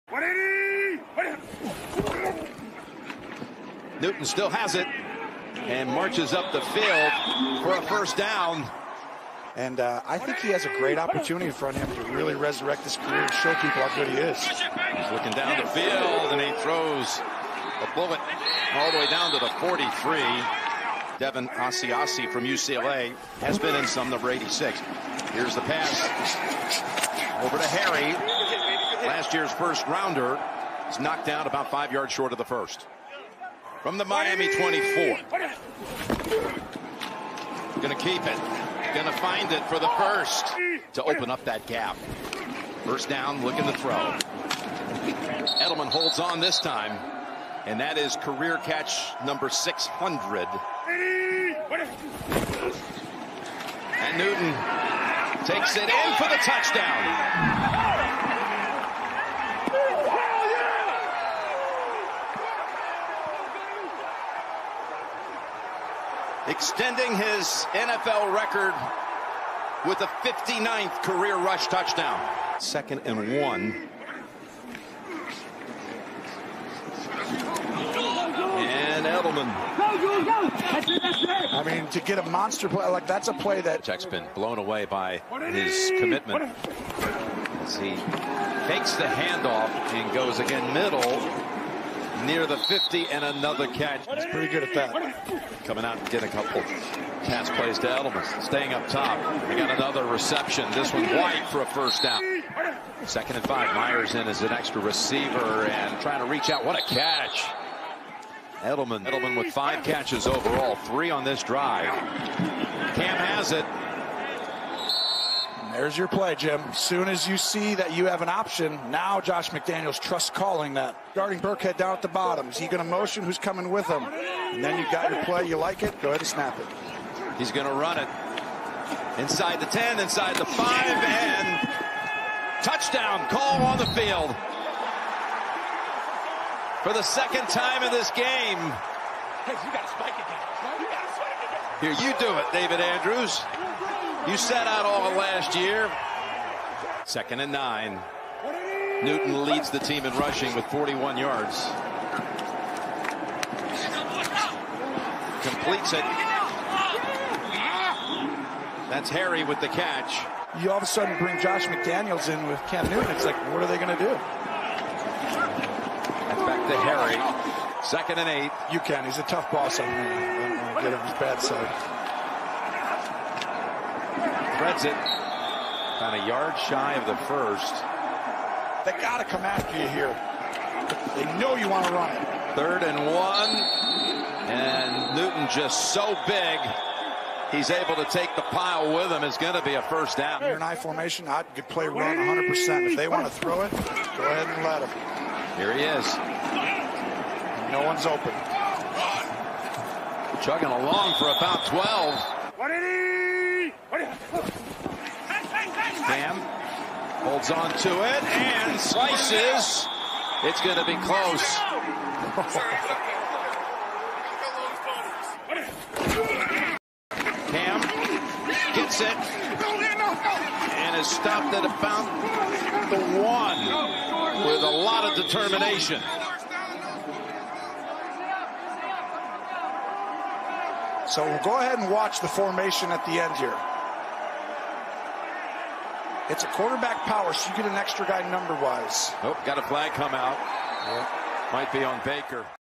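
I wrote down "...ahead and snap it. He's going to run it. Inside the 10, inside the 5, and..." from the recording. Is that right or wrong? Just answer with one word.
right.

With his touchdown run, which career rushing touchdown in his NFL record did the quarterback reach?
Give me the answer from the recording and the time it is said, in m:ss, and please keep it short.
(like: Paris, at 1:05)
59th, at 1:10.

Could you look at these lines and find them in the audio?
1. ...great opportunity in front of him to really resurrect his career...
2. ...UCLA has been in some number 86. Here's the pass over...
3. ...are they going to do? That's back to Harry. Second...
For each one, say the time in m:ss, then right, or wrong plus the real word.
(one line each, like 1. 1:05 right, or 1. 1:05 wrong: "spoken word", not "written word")
1. 0:10 right
2. 0:22 right
3. 2:43 right.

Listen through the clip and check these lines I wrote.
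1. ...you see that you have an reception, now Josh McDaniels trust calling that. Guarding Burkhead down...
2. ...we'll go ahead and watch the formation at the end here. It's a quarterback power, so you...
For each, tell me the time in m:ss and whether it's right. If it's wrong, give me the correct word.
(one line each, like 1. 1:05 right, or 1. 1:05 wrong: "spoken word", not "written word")
1. 1:57 wrong: "option", not "reception"
2. 3:51 right.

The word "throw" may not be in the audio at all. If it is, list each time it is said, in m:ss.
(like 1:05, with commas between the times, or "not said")
0:16, 0:43, 3:13.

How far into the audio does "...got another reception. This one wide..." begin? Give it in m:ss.
1:39.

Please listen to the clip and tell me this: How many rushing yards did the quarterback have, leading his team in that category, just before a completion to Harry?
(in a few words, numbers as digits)
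41.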